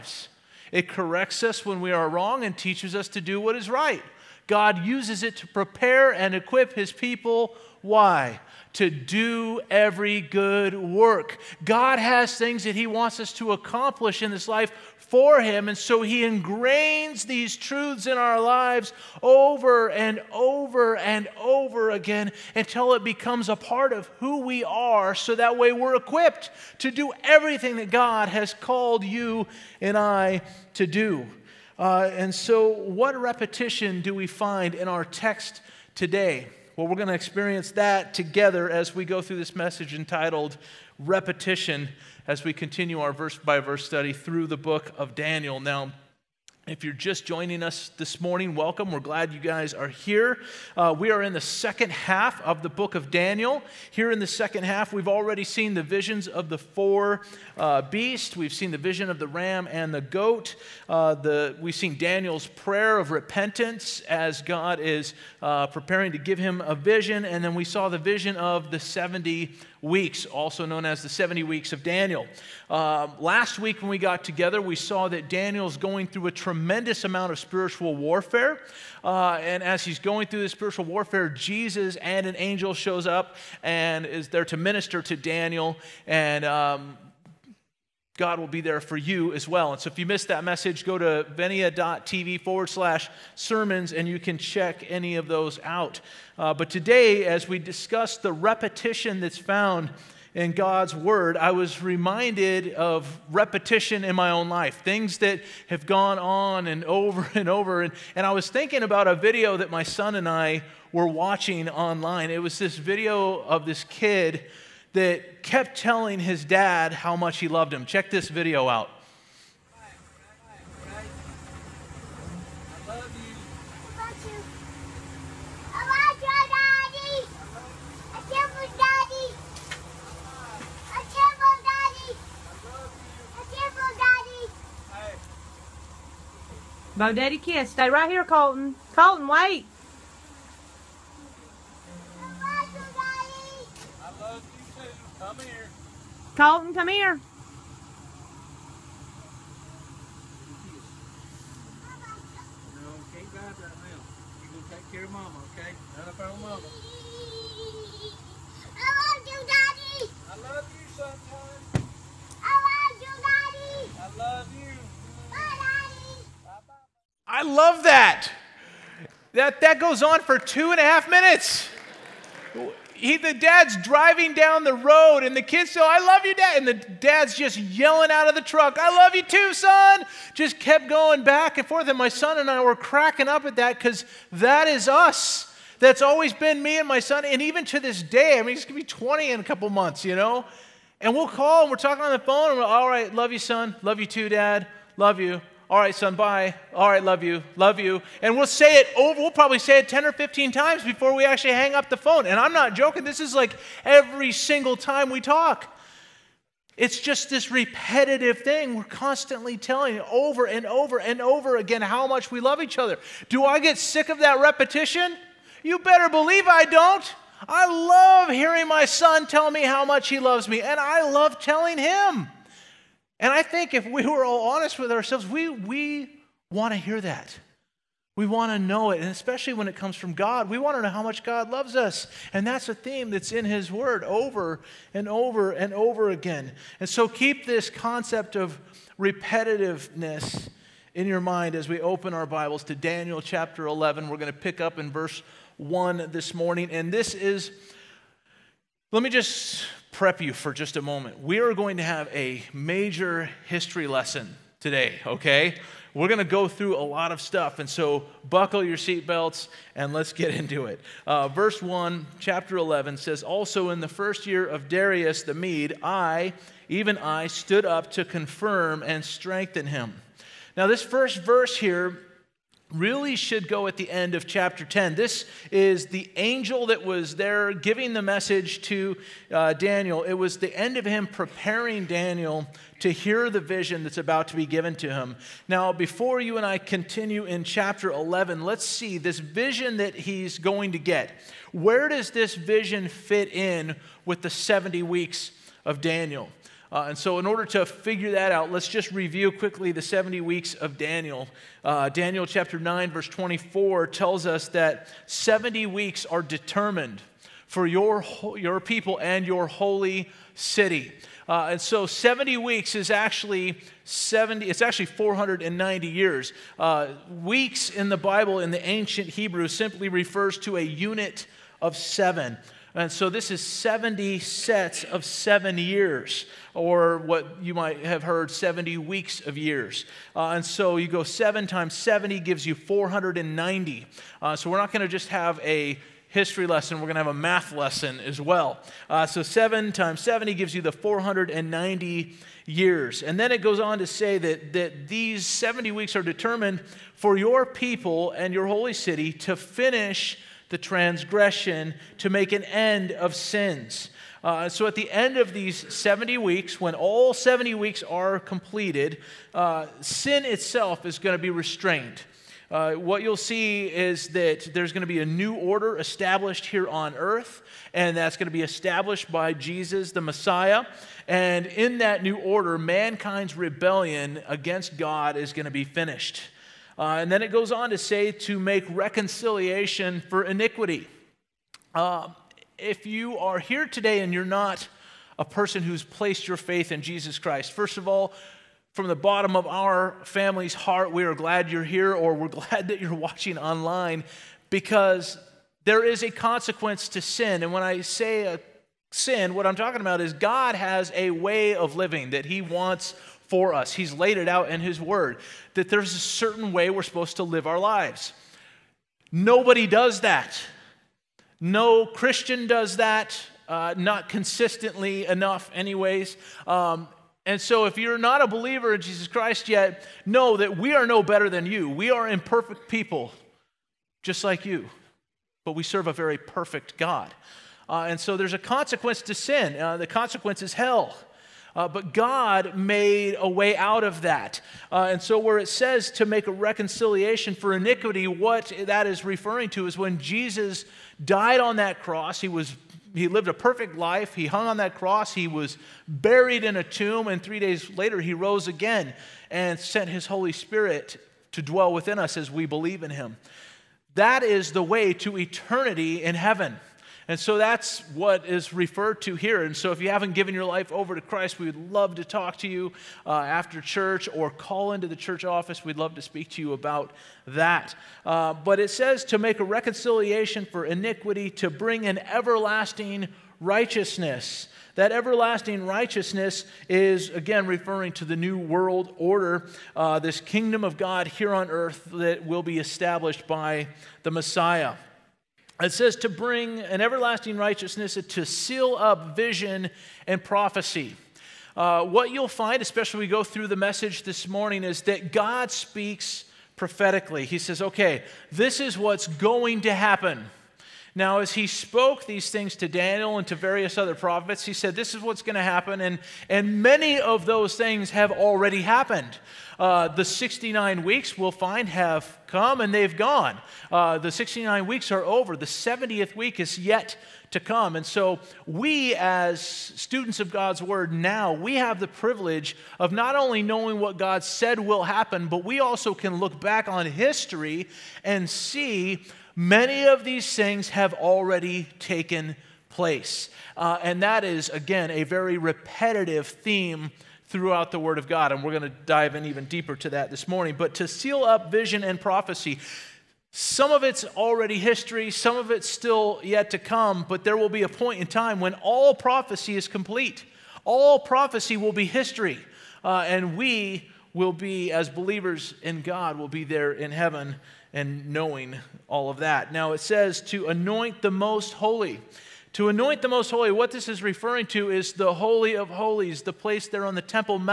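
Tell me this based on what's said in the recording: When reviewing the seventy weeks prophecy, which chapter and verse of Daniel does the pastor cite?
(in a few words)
Chapter 9, verse 24.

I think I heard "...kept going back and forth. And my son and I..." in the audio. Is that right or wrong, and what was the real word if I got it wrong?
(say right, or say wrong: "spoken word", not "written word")
right.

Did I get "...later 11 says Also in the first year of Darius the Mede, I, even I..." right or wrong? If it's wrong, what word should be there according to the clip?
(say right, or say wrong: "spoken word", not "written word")
wrong: "chapter", not "later".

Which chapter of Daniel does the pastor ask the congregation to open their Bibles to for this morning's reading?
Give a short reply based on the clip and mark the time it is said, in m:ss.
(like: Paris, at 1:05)
Chapter 11, at 4:02.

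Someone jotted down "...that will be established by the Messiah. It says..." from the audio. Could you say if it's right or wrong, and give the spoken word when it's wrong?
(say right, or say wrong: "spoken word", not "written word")
right.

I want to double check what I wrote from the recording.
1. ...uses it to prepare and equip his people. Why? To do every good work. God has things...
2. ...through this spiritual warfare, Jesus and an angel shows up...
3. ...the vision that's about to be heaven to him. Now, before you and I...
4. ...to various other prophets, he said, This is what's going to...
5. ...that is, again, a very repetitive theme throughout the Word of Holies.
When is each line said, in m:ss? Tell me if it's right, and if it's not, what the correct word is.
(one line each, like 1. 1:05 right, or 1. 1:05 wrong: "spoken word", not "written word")
1. 0:04 right
2. 1:20 right
3. 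4:43 wrong: "given", not "heaven"
4. 8:23 right
5. 8:54 wrong: "God", not "Holies".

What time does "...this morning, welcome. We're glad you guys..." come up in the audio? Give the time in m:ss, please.
0:47.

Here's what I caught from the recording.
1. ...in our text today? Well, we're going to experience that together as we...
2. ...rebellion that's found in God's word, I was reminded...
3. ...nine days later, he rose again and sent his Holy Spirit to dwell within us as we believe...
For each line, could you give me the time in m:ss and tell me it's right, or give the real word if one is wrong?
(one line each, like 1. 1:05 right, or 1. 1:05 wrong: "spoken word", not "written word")
1. 0:34 right
2. 1:38 wrong: "repetition", not "rebellion"
3. 7:27 wrong: "three", not "nine".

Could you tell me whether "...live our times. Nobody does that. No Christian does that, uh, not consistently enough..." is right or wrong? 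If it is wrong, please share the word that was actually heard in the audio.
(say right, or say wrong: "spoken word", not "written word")
wrong: "lives", not "times".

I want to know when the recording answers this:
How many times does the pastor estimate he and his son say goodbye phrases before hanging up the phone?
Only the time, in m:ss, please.
3:19.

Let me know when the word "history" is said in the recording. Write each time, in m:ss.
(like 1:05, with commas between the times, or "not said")
4:13, 5:36, 8:46, 9:04, 9:11.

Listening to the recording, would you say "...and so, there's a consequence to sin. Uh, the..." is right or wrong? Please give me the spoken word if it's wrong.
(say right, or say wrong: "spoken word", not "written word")
right.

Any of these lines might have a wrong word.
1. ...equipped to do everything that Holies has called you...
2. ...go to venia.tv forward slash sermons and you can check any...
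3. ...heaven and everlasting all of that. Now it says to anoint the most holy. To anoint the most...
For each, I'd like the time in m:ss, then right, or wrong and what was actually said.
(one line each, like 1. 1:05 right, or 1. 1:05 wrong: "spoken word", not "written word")
1. 0:25 wrong: "God", not "Holies"
2. 1:30 right
3. 9:16 wrong: "knowing", not "everlasting".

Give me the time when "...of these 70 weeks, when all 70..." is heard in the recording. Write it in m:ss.
5:55.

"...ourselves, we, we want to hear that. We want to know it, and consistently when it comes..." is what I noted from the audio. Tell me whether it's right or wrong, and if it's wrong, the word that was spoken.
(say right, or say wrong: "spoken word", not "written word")
wrong: "especially", not "consistently".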